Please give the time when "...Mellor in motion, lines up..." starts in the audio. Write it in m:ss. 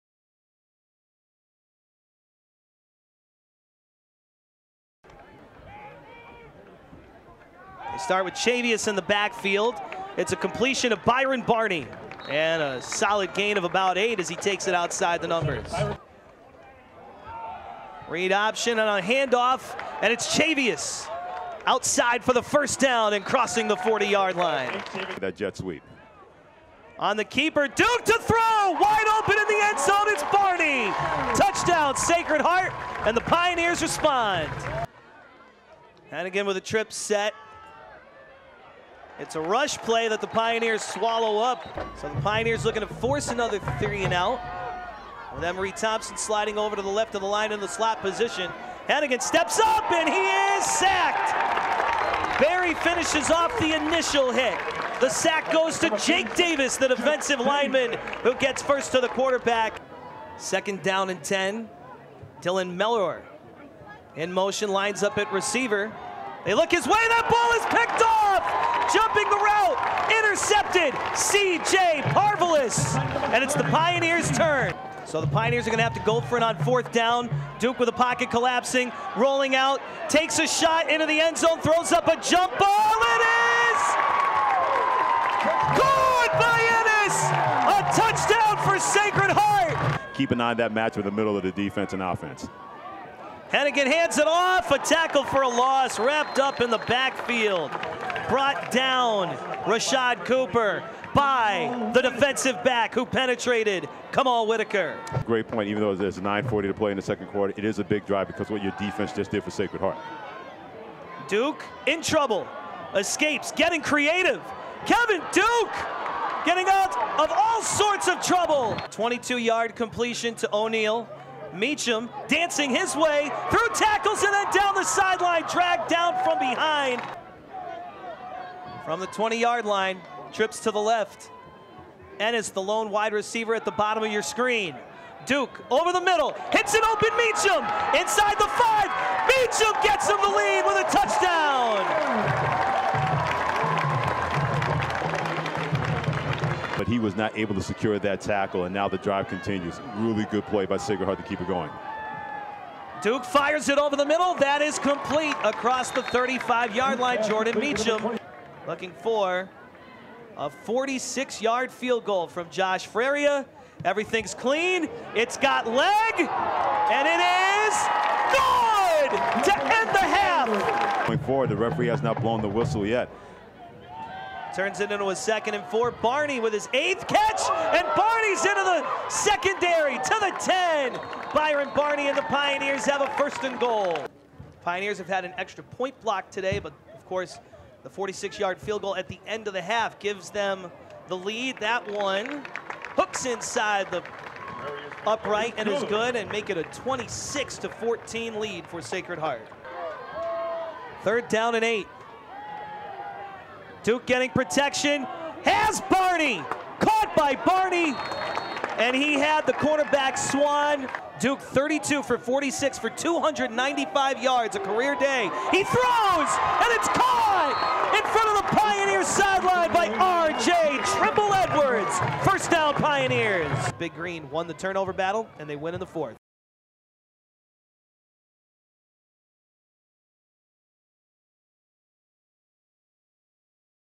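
1:02.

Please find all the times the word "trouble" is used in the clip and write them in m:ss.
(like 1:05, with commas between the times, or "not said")
1:52, 1:58.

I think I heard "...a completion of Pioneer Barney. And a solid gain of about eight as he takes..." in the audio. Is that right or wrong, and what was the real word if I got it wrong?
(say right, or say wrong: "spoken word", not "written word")
wrong: "Byron", not "Pioneer".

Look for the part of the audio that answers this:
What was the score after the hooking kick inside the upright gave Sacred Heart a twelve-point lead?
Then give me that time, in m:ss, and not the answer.
3:16.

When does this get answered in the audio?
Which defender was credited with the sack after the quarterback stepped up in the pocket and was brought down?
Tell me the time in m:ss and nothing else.
0:55.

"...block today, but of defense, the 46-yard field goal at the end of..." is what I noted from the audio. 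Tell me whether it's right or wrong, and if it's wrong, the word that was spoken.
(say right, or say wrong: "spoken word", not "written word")
wrong: "course", not "defense".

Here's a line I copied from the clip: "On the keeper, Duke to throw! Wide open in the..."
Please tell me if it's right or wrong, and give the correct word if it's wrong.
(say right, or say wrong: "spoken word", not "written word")
right.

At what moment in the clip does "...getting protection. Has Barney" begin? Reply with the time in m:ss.
3:24.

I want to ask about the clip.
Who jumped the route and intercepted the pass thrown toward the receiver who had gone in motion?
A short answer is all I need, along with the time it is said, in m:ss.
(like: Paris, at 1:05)
C.J. Parvelis, at 1:11.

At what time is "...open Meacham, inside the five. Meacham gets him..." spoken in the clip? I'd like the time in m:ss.
2:16.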